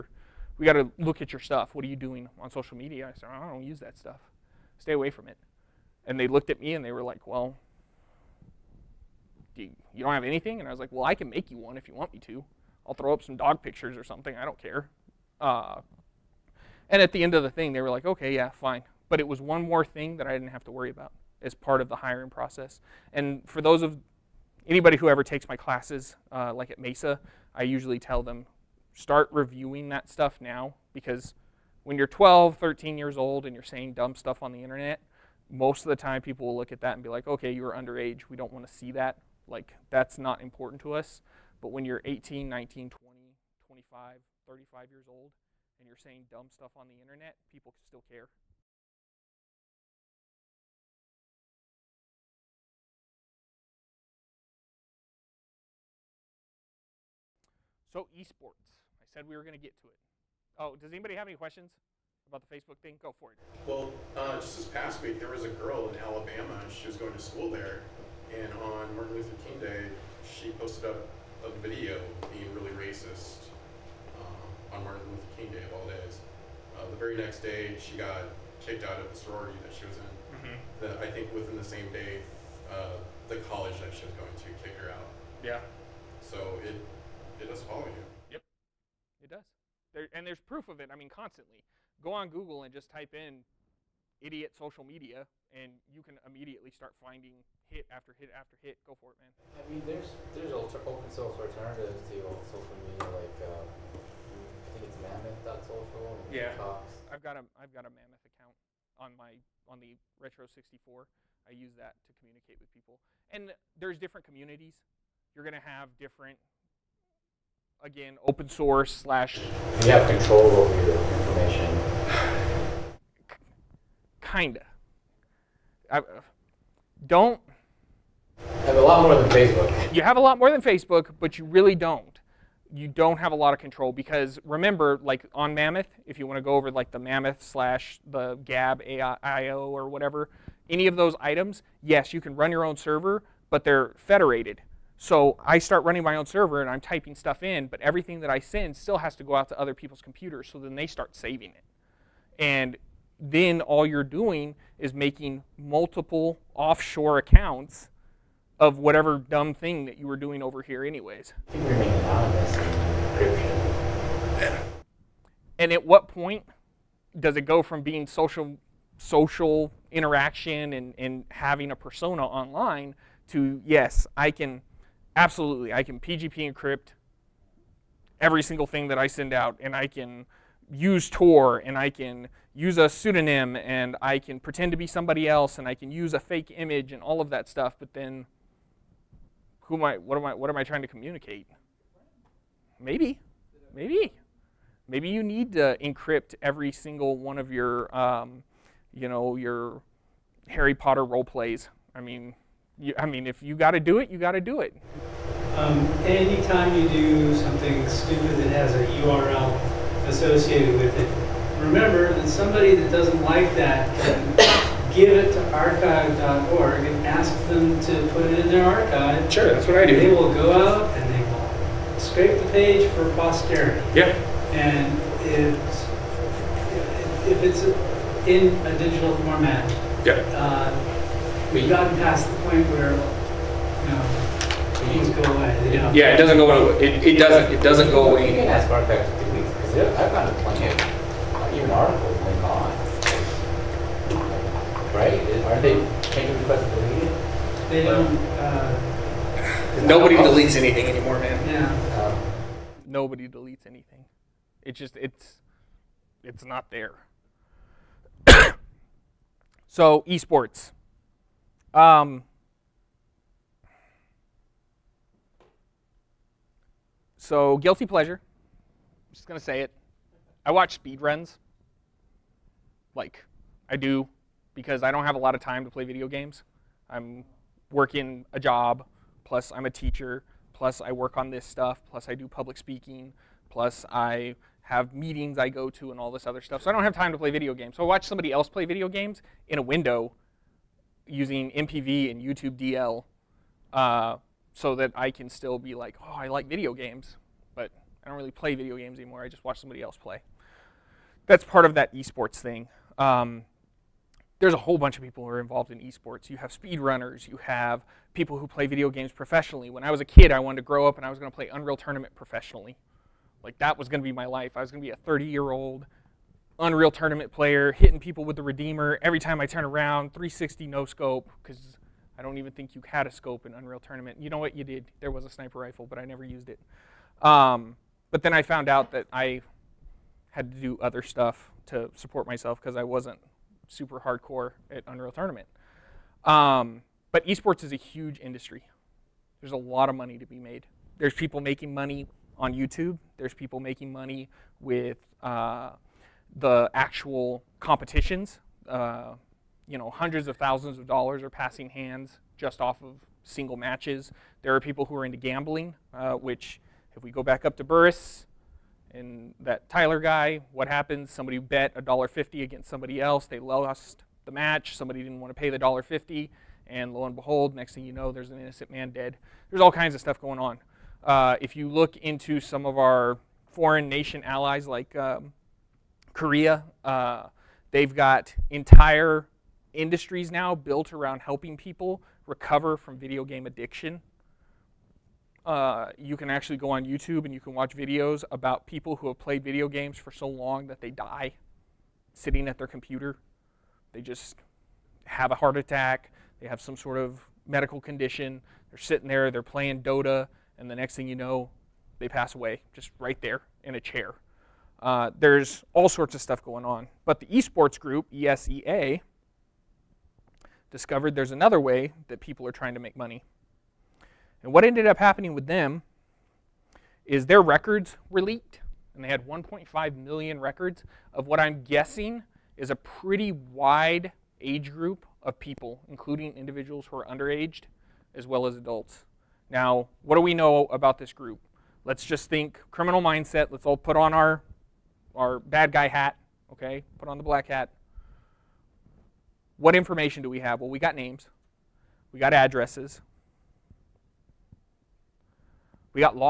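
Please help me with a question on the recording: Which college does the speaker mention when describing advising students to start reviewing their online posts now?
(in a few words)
Mesa.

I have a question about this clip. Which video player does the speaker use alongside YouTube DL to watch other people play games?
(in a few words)
MPV.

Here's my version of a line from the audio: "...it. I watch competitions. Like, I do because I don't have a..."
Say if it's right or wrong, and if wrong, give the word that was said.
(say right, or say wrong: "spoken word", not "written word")
wrong: "speedruns", not "competitions".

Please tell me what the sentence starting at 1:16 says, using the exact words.
Uh, the very next day, she got kicked out of the sorority that she was in.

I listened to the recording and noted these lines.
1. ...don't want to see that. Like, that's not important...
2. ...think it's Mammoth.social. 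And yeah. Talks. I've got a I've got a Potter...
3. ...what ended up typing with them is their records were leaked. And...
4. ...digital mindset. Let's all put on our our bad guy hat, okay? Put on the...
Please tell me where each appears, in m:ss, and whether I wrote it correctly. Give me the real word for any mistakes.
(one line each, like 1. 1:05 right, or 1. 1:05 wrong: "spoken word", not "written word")
1. 0:38 right
2. 1:44 wrong: "Mammoth", not "Potter"
3. 6:54 wrong: "happening", not "typing"
4. 7:12 wrong: "criminal", not "digital".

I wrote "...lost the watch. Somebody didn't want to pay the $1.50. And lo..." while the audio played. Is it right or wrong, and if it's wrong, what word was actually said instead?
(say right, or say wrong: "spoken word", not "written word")
wrong: "match", not "watch".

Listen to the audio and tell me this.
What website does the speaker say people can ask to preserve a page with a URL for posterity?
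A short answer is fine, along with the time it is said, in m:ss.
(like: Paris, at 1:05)
archive.org, at 3:35.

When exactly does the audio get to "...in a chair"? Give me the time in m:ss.
6:43.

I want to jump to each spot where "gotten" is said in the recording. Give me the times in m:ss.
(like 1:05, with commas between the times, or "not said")
3:51, 4:00.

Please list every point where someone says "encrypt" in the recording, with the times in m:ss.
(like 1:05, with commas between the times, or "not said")
2:56, 3:15.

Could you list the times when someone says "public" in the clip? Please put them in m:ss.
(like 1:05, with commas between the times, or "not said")
4:42.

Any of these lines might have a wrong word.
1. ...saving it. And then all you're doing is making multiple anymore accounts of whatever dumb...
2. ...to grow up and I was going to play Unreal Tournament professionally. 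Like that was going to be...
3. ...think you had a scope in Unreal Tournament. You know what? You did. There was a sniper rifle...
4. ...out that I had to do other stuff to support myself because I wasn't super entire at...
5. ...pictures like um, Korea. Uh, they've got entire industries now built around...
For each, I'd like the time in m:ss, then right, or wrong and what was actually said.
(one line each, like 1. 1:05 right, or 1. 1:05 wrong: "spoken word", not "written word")
1. 2:31 wrong: "offshore", not "anymore"
2. 5:10 right
3. 5:22 right
4. 5:28 wrong: "hardcore", not "entire"
5. 6:14 wrong: "allies", not "pictures".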